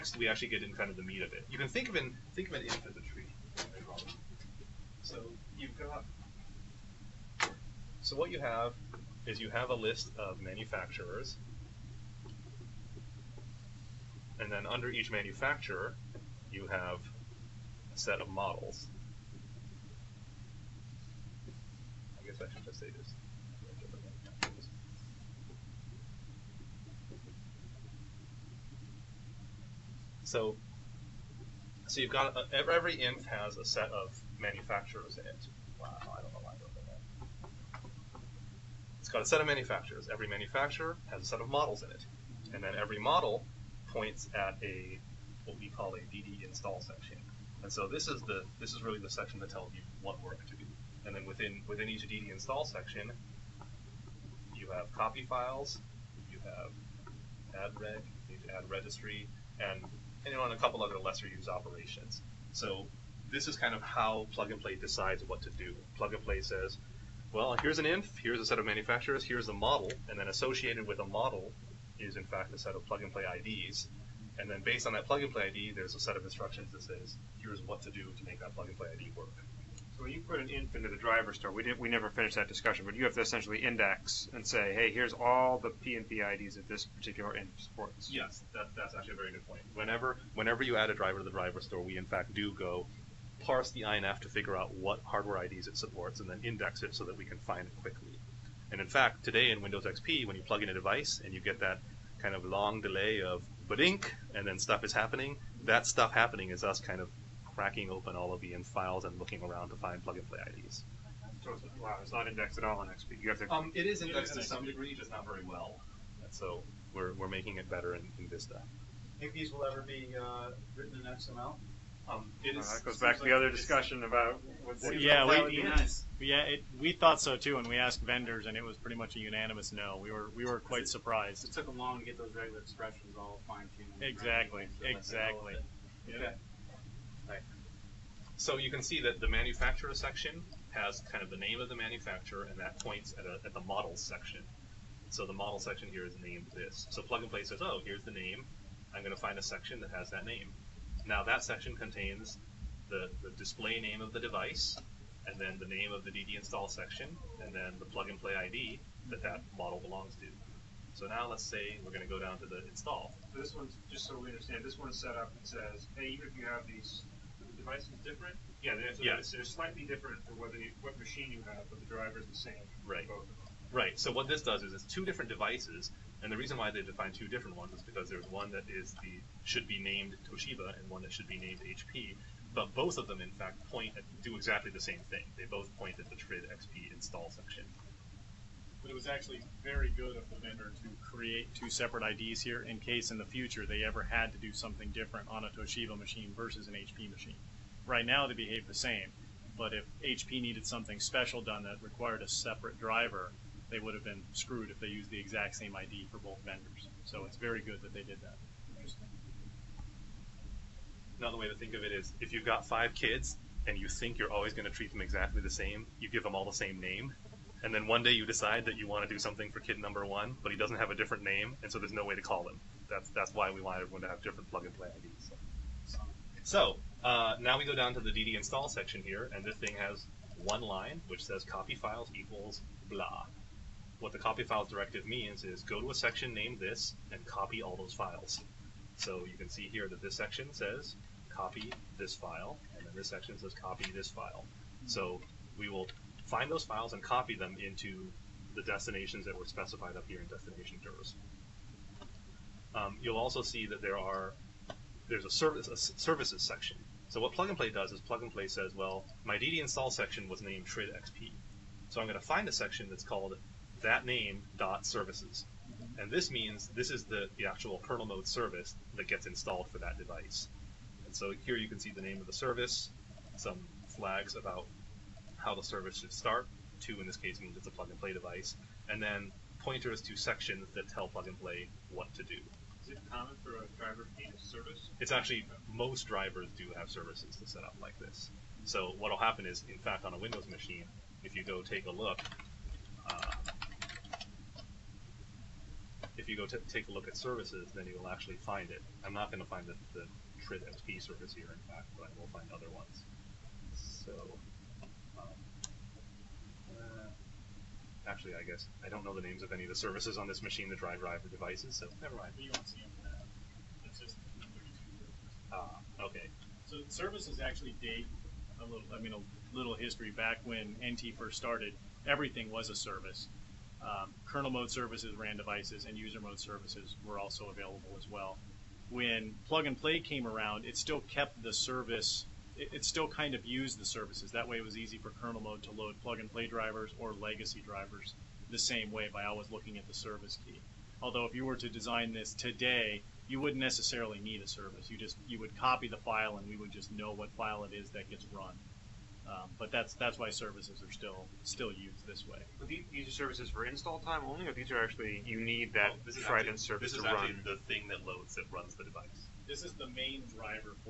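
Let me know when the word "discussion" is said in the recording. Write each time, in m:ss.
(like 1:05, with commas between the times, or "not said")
1:22, 2:03.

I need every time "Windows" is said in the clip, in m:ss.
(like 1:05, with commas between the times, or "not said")
1:39, 4:50.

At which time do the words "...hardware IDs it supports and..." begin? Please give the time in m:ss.
1:35.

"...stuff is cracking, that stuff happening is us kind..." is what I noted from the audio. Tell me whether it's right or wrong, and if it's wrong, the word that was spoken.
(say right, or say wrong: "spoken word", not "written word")
wrong: "happening", not "cracking".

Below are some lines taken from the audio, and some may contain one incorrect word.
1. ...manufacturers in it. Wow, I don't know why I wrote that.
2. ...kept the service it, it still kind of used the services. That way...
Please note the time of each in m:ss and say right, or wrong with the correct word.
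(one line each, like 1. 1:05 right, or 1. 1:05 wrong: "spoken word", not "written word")
1. 0:34 right
2. 5:31 right.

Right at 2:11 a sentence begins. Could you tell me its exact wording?
It took them long to get those regular expressions all fine tuned.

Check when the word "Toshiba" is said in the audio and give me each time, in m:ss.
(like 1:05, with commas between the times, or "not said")
3:00, 3:15.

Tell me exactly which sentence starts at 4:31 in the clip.
And so here you can see the name of the service, some flags about how the service should start.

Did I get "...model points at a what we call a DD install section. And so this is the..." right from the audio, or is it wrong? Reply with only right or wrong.
right.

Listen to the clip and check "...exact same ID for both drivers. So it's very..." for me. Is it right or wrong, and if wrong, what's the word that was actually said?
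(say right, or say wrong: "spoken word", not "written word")
wrong: "vendors", not "drivers".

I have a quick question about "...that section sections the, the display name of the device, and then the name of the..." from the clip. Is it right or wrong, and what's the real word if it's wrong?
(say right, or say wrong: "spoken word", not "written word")
wrong: "contains", not "sections".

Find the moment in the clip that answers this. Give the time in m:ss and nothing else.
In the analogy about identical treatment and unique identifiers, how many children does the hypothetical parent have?
3:32.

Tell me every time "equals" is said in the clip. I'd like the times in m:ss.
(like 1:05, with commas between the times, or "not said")
3:52.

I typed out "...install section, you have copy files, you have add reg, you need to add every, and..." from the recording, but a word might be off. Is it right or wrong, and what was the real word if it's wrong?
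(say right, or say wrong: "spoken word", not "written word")
wrong: "registry", not "every".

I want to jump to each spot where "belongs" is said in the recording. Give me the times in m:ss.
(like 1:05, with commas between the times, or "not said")
2:39.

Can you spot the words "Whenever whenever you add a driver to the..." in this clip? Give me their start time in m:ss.
1:29.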